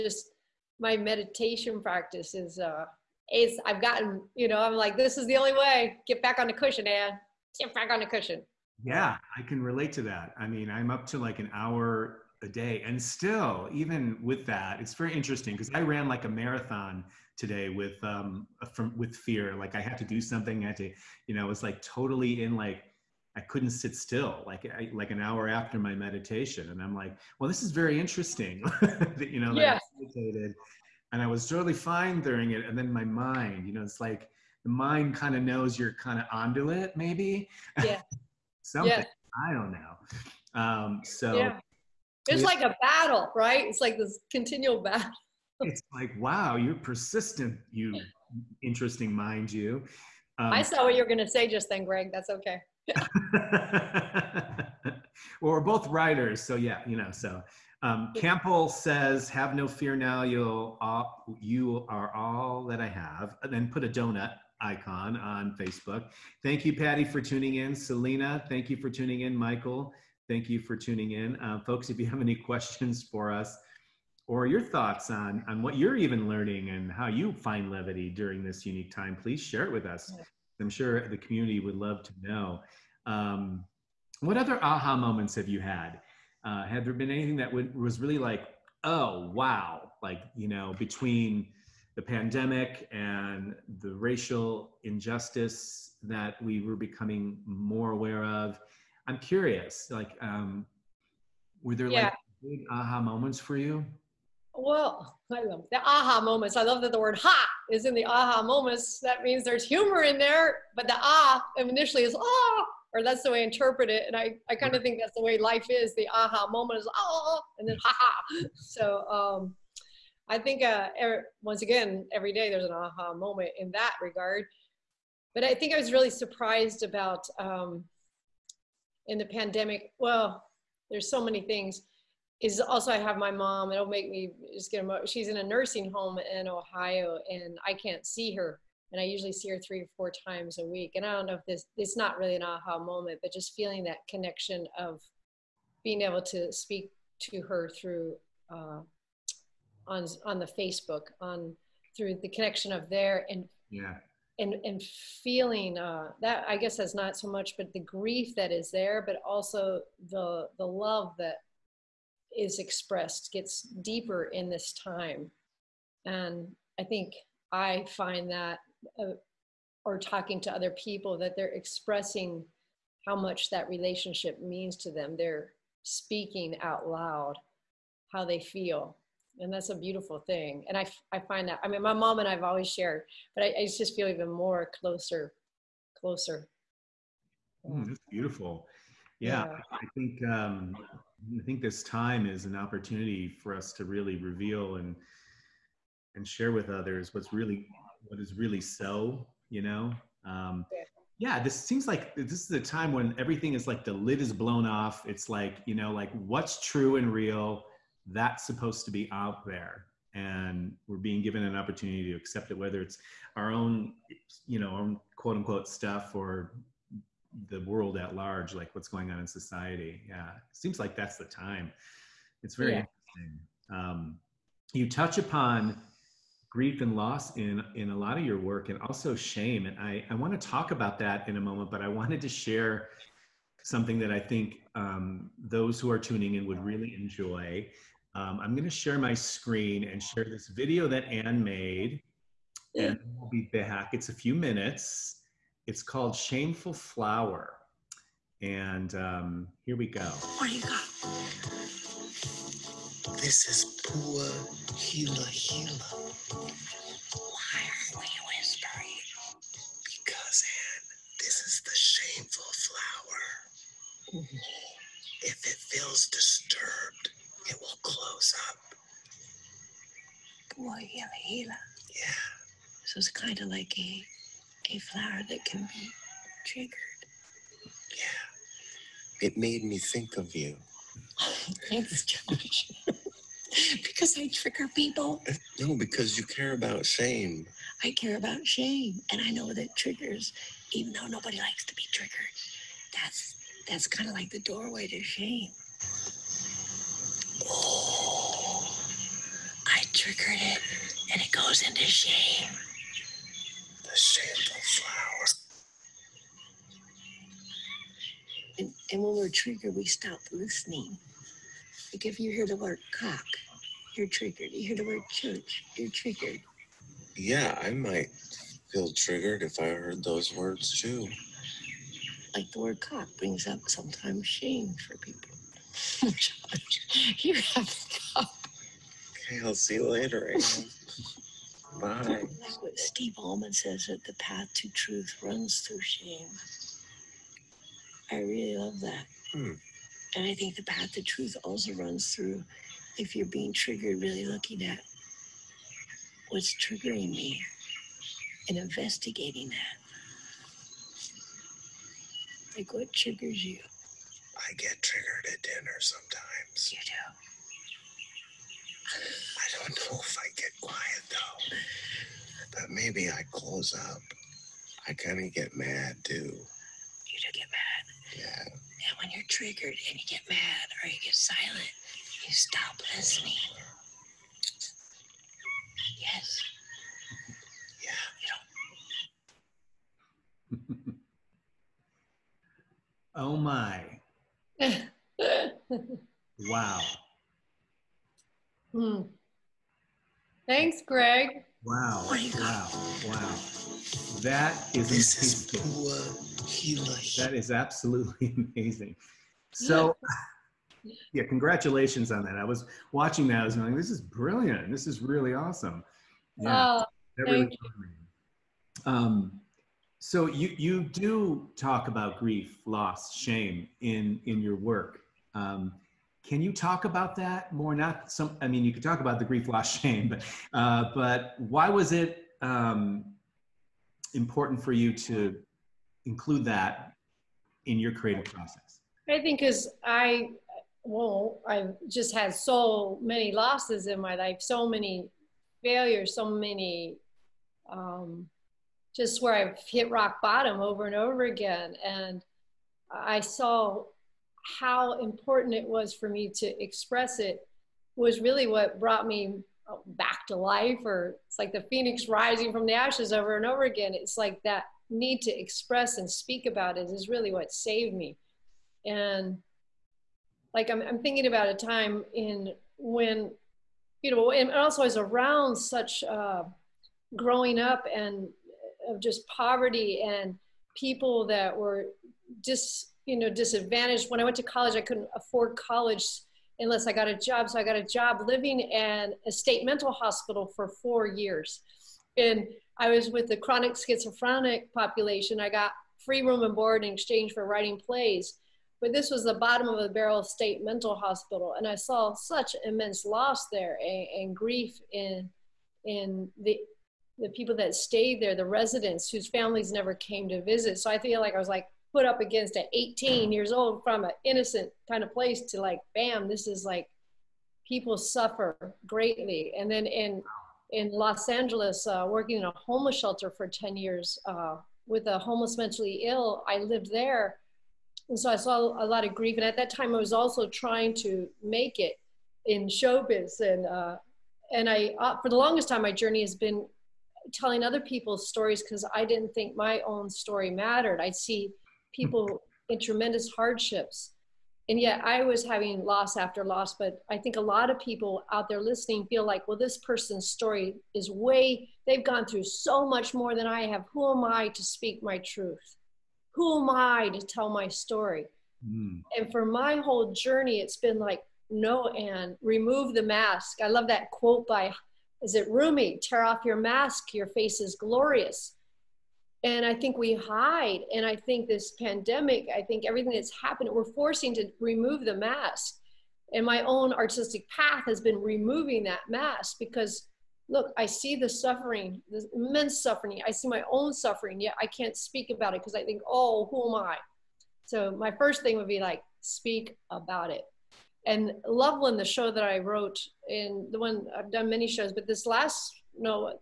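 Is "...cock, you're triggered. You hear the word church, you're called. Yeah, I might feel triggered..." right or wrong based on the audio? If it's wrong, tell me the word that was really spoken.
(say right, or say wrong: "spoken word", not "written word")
wrong: "triggered", not "called".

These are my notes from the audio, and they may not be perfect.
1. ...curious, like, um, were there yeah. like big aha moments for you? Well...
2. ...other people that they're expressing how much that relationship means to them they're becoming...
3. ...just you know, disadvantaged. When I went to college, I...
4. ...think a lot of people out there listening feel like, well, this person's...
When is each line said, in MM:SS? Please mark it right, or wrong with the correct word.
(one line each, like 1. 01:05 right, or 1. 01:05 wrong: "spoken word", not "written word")
1. 01:39 right
2. 02:50 wrong: "speaking", not "becoming"
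3. 07:52 right
4. 08:57 right.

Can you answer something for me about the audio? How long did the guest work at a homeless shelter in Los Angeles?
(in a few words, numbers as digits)
10 years.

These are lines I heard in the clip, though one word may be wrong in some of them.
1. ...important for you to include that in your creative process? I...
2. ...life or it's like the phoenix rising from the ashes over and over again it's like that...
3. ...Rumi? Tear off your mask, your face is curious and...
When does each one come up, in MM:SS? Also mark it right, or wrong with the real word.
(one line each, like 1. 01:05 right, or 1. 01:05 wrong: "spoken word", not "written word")
1. 07:04 right
2. 07:30 right
3. 09:15 wrong: "glorious", not "curious".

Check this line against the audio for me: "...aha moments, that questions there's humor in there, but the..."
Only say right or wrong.
wrong.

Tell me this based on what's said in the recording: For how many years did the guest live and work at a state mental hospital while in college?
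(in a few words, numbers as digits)
4.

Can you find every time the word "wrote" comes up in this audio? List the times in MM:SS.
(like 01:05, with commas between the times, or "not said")
09:42.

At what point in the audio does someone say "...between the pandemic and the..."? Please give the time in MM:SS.
01:30.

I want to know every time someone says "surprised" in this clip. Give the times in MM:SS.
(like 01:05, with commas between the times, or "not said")
02:06.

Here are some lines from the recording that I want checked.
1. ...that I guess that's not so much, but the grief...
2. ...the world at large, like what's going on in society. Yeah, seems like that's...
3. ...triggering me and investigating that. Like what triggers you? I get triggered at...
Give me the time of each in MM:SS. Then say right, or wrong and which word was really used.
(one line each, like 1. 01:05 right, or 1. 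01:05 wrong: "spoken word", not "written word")
1. 02:36 right
2. 03:37 right
3. 05:46 right.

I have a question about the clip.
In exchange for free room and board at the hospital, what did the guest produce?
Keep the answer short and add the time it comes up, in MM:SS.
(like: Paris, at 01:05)
plays, at 08:07.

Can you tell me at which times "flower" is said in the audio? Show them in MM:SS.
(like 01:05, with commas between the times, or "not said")
04:06, 04:24, 04:34, 05:04.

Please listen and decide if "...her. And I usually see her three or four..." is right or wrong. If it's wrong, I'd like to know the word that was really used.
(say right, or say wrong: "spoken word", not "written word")
right.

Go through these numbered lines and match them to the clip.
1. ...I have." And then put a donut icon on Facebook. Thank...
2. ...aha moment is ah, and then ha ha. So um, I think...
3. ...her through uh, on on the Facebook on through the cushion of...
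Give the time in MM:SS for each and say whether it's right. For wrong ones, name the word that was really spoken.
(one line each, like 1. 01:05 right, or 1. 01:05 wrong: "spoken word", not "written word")
1. 01:02 right
2. 01:56 right
3. 02:27 wrong: "connection", not "cushion".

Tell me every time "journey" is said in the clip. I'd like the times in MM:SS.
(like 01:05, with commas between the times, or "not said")
08:45, 09:10.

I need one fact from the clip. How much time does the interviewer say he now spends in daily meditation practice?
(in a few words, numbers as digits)
an hour a day.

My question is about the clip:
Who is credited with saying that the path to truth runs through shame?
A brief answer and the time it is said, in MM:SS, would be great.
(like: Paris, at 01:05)
Steve Allman, at 05:32.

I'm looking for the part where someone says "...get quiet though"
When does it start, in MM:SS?
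06:00.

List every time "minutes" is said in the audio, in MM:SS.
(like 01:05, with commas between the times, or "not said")
04:04.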